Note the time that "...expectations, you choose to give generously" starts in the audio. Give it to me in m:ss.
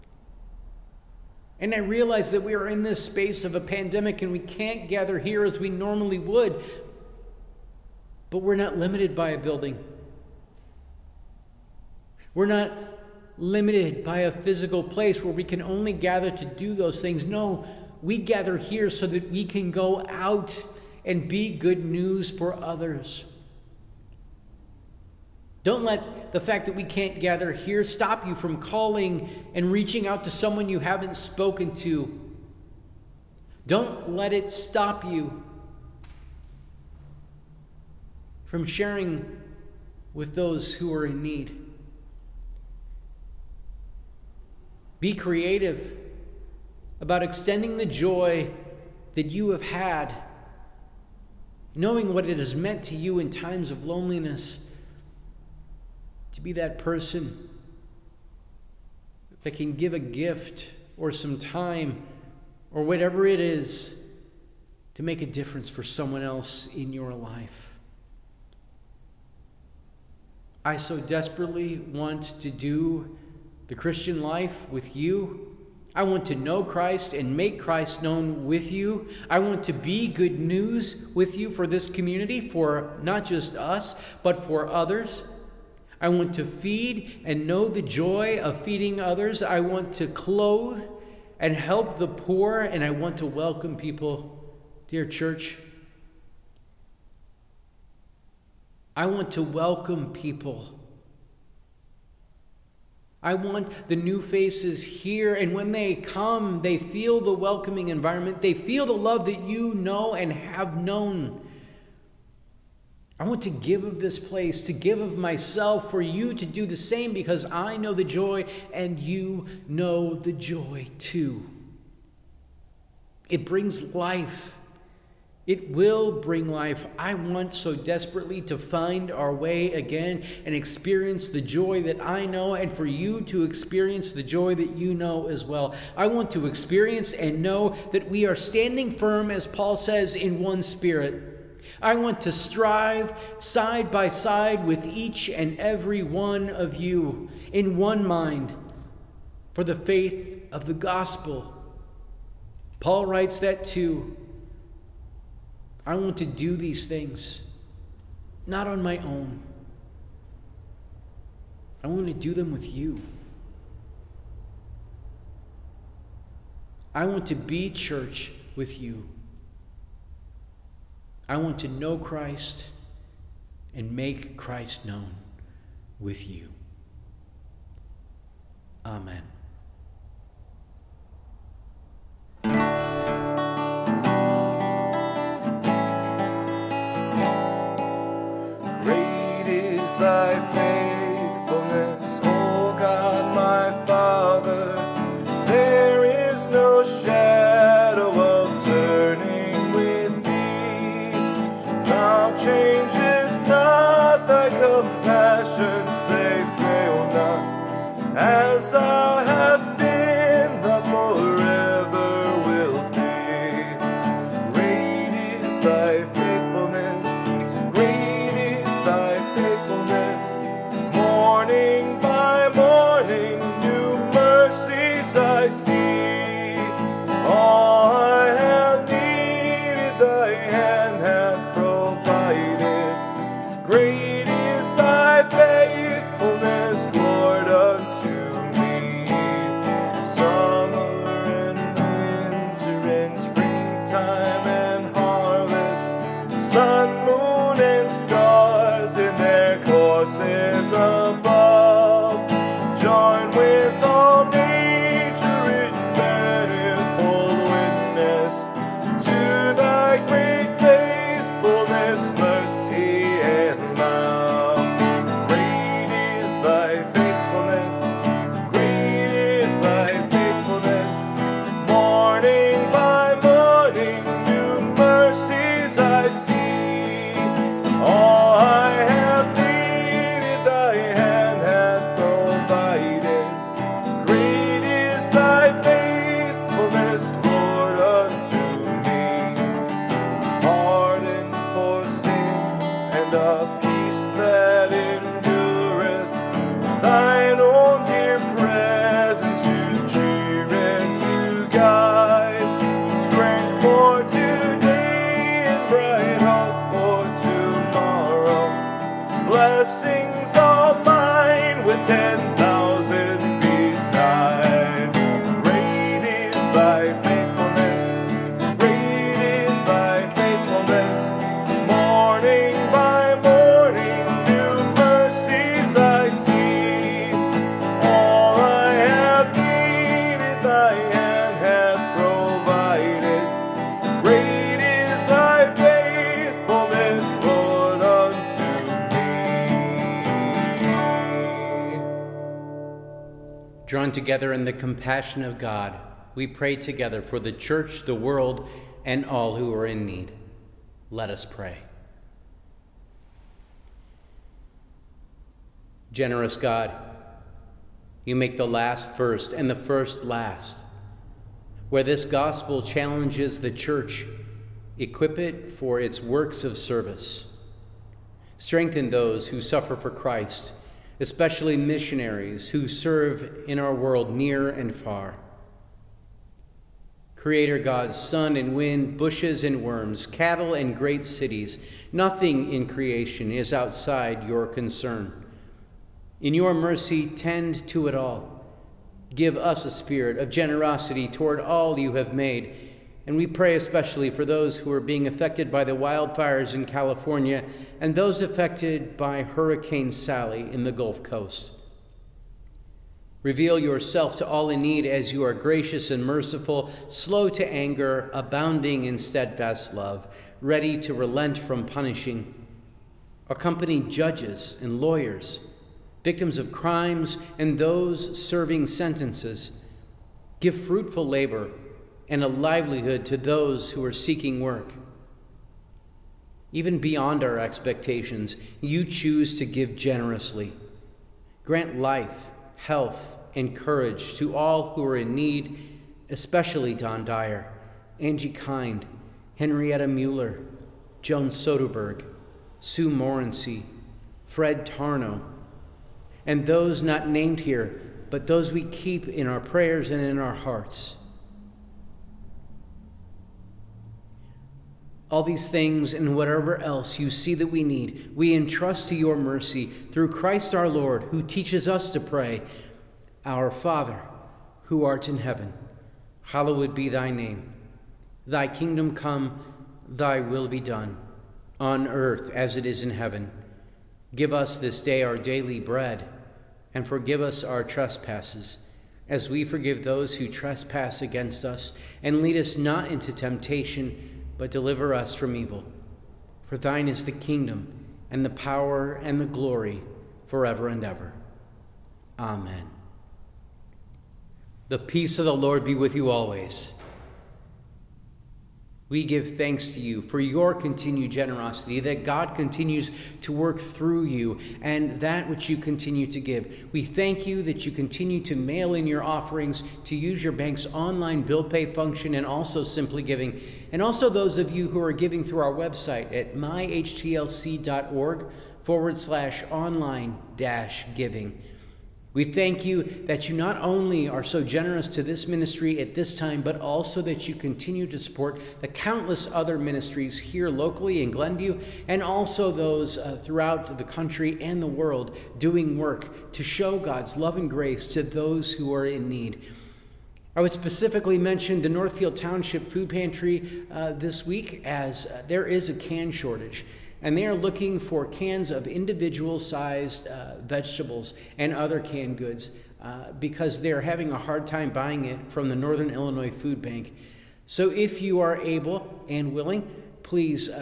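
7:07.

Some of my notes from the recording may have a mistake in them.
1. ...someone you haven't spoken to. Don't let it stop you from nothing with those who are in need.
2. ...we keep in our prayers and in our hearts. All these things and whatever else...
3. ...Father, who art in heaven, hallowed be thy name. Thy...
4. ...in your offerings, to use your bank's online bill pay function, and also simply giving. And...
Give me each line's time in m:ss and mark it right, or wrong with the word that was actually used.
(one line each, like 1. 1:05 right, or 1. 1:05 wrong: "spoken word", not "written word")
1. 0:30 wrong: "sharing", not "nothing"
2. 7:28 right
3. 7:43 right
4. 8:28 right.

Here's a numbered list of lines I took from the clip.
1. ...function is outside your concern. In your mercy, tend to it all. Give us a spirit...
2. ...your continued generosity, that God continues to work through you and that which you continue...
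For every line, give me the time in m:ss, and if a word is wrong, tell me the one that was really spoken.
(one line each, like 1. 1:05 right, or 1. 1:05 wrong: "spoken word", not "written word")
1. 6:22 wrong: "creation", not "function"
2. 8:20 right.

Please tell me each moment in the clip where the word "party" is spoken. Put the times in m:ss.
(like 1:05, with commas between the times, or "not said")
not said.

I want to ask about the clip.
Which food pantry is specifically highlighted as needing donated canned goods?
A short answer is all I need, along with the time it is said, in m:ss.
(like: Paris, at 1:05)
Northfield Township Food Pantry, at 9:01.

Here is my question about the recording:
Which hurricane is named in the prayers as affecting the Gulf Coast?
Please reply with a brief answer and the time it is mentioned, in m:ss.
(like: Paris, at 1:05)
Hurricane Sally, at 6:39.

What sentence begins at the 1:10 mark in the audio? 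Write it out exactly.
I so desperately want to do the Christian life with you I want to know Christ and make Christ known with you.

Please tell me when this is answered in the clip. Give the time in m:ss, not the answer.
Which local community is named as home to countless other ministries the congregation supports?
8:51.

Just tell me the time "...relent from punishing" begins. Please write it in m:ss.
6:50.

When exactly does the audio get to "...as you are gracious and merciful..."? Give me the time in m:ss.
6:44.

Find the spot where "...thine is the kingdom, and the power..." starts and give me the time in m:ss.
8:06.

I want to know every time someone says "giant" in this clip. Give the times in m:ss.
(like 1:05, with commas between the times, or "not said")
not said.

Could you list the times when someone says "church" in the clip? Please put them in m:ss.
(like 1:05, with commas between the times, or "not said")
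1:35, 2:47, 5:47, 6:03.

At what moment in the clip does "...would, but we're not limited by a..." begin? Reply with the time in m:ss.
0:06.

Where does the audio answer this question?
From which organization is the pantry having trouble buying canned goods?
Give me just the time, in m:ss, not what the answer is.
9:15.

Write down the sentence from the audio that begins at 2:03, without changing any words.
It brings life it will bring life.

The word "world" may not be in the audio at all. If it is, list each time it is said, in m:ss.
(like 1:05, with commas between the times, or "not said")
5:47, 6:13, 8:54.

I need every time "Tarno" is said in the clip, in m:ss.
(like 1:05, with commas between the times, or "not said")
7:24.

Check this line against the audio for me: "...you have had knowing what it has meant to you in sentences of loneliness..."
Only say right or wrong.
wrong.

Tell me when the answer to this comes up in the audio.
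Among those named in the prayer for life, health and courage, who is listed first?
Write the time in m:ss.
7:16.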